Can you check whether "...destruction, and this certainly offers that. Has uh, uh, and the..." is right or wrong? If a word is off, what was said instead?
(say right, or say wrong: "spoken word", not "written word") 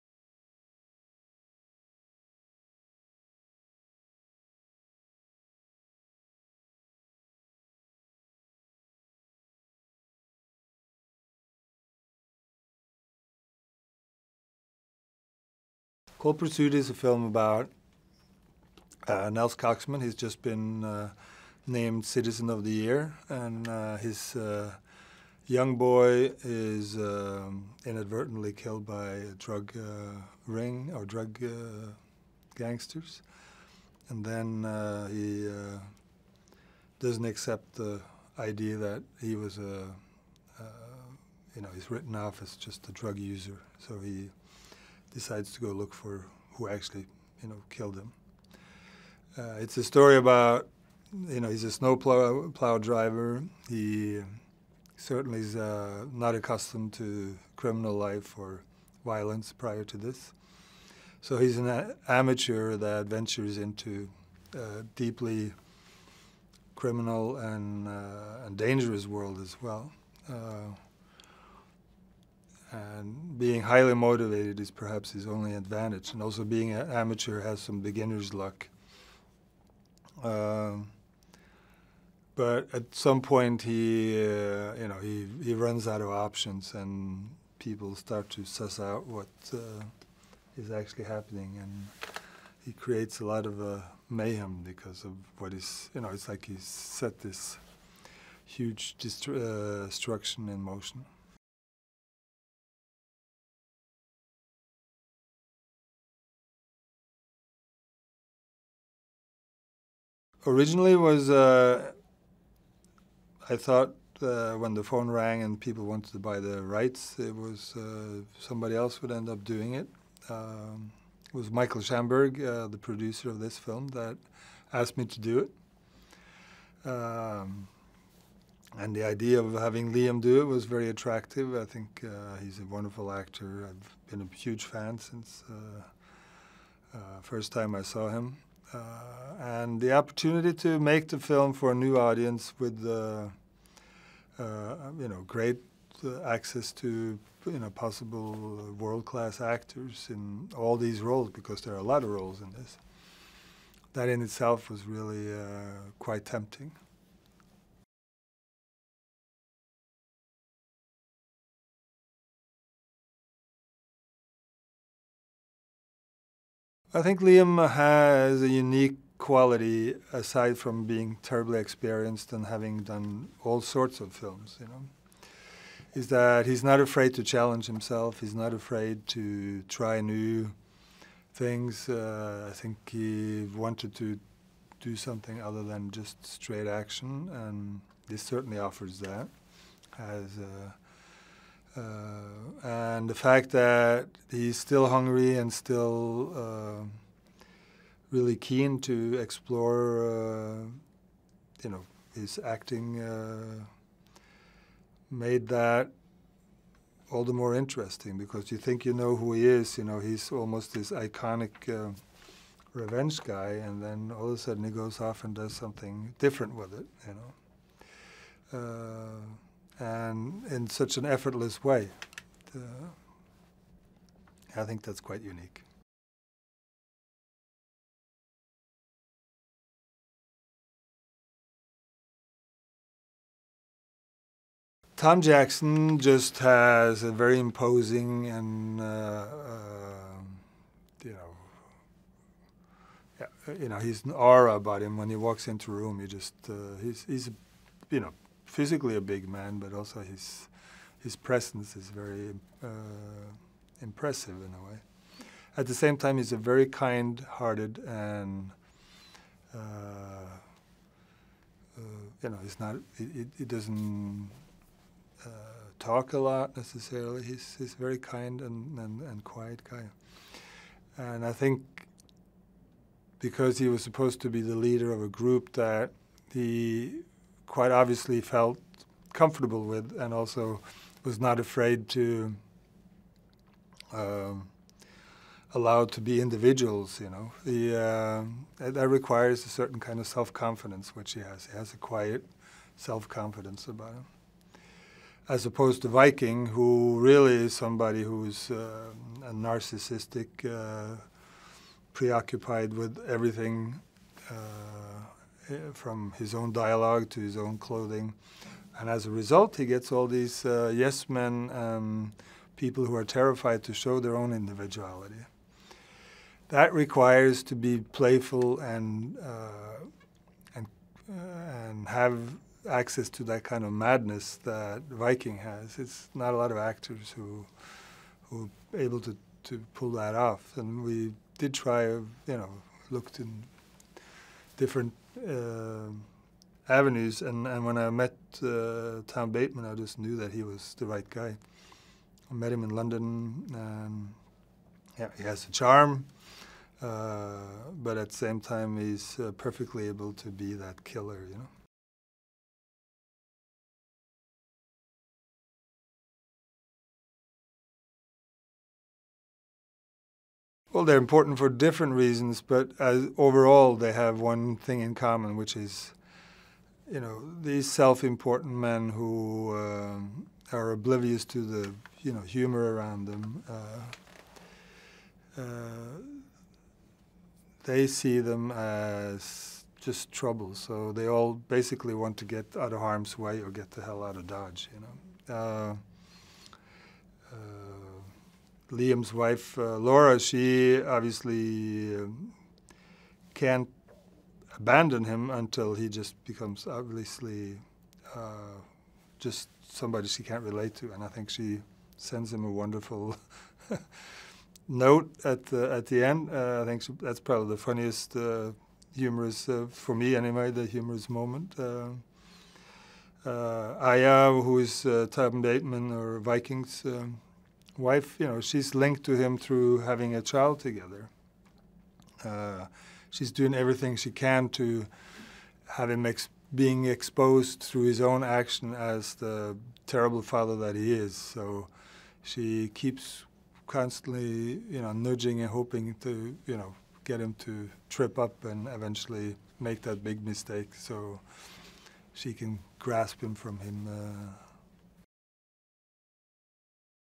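wrong: "action", not "destruction".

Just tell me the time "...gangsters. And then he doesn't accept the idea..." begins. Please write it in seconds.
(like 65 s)
32 s.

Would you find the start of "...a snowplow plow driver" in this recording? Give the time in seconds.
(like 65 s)
51 s.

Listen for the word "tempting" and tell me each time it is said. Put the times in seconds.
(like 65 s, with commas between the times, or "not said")
156 s.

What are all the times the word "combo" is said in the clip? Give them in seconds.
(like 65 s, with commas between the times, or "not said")
not said.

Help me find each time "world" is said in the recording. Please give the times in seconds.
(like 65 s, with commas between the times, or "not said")
69 s, 148 s.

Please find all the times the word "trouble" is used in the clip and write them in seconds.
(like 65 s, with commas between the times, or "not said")
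380 s.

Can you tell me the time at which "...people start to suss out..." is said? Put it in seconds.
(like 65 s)
87 s.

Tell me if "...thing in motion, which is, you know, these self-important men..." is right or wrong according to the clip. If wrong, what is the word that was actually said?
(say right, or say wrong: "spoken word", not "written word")
wrong: "common", not "motion".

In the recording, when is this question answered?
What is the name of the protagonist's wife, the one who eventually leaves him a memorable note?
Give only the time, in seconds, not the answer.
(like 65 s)
389 s.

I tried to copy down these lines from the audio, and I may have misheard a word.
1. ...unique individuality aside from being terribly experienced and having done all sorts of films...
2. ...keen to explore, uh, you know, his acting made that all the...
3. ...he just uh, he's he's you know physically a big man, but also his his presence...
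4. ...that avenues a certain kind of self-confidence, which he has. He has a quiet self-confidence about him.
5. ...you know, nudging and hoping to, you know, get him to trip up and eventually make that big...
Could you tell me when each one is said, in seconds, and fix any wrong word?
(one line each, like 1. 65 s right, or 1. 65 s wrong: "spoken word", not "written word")
1. 168 s wrong: "quality", not "individuality"
2. 198 s right
3. 245 s right
4. 288 s wrong: "requires", not "avenues"
5. 434 s right.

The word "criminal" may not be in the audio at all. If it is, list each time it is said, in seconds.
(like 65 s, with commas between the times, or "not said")
57 s, 66 s.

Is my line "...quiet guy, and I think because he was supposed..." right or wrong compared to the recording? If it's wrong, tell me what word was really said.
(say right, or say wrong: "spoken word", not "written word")
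right.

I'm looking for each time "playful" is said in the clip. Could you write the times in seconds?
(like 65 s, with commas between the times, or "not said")
317 s.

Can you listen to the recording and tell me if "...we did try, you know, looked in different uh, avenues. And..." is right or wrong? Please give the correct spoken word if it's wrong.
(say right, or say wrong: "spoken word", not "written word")
right.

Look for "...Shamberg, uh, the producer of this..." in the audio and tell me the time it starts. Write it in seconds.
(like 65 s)
121 s.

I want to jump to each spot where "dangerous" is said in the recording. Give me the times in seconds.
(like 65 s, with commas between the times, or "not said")
68 s.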